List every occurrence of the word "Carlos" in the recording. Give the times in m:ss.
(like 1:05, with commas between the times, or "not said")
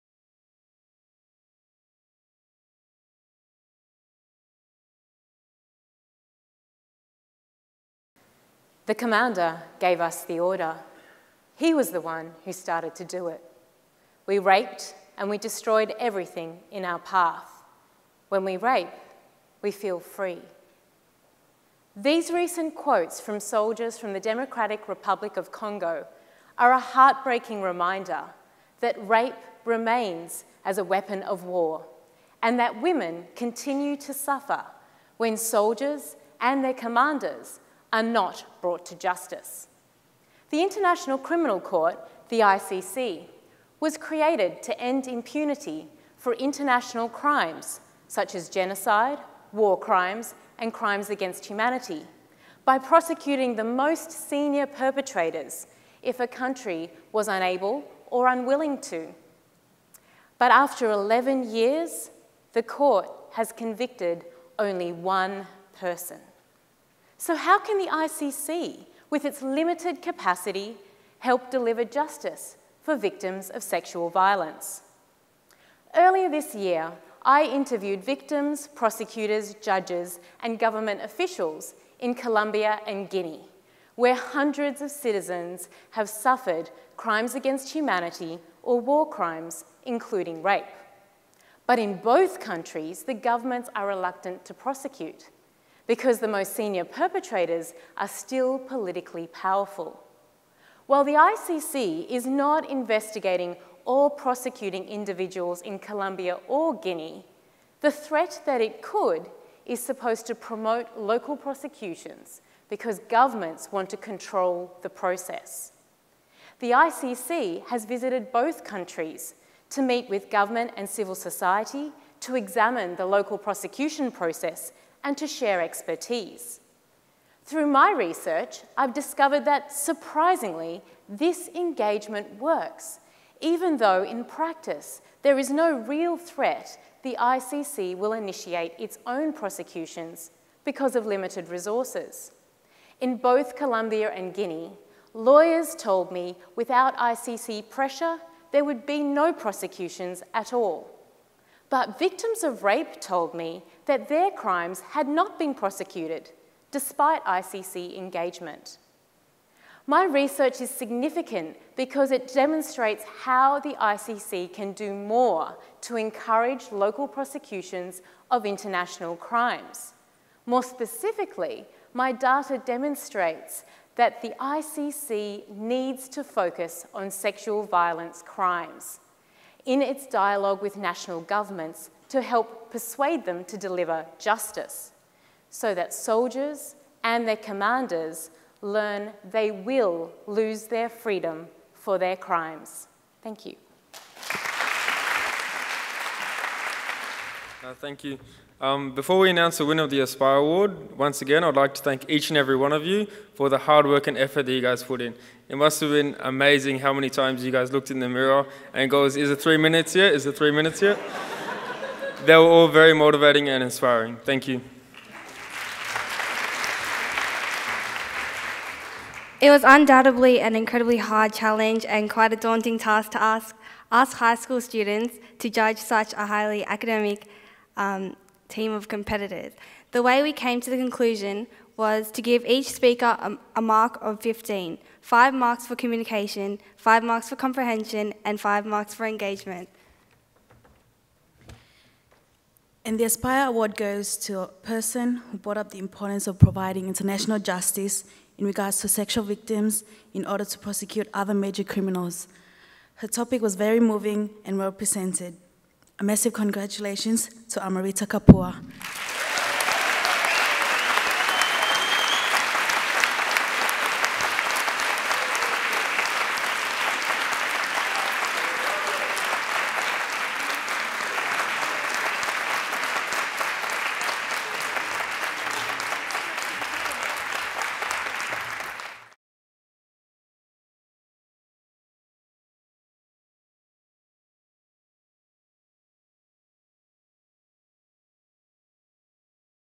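not said.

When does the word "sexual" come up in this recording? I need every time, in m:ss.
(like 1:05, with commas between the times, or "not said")
1:13, 2:57, 4:08.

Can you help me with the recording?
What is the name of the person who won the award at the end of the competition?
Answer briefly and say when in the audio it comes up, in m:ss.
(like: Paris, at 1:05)
Amarita Kapur, at 4:17.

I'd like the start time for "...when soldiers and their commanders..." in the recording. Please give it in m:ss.
0:35.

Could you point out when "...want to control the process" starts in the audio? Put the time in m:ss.
1:53.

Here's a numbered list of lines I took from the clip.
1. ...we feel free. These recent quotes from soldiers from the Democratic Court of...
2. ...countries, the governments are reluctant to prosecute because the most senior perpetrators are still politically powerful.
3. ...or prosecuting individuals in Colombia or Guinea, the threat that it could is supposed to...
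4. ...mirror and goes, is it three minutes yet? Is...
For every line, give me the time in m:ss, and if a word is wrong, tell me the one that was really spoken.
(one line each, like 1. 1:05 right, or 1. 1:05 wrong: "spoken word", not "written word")
1. 0:19 wrong: "Republic", not "Court"
2. 1:32 right
3. 1:43 right
4. 3:28 right.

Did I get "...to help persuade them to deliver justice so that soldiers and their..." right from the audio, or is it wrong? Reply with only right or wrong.
right.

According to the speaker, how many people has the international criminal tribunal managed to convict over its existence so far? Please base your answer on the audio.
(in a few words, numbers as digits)
1.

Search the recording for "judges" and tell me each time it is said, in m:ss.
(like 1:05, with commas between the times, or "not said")
1:19, 3:45.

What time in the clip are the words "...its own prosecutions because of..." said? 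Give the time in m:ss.
2:18.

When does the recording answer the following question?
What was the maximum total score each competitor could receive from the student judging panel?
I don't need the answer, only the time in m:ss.
3:54.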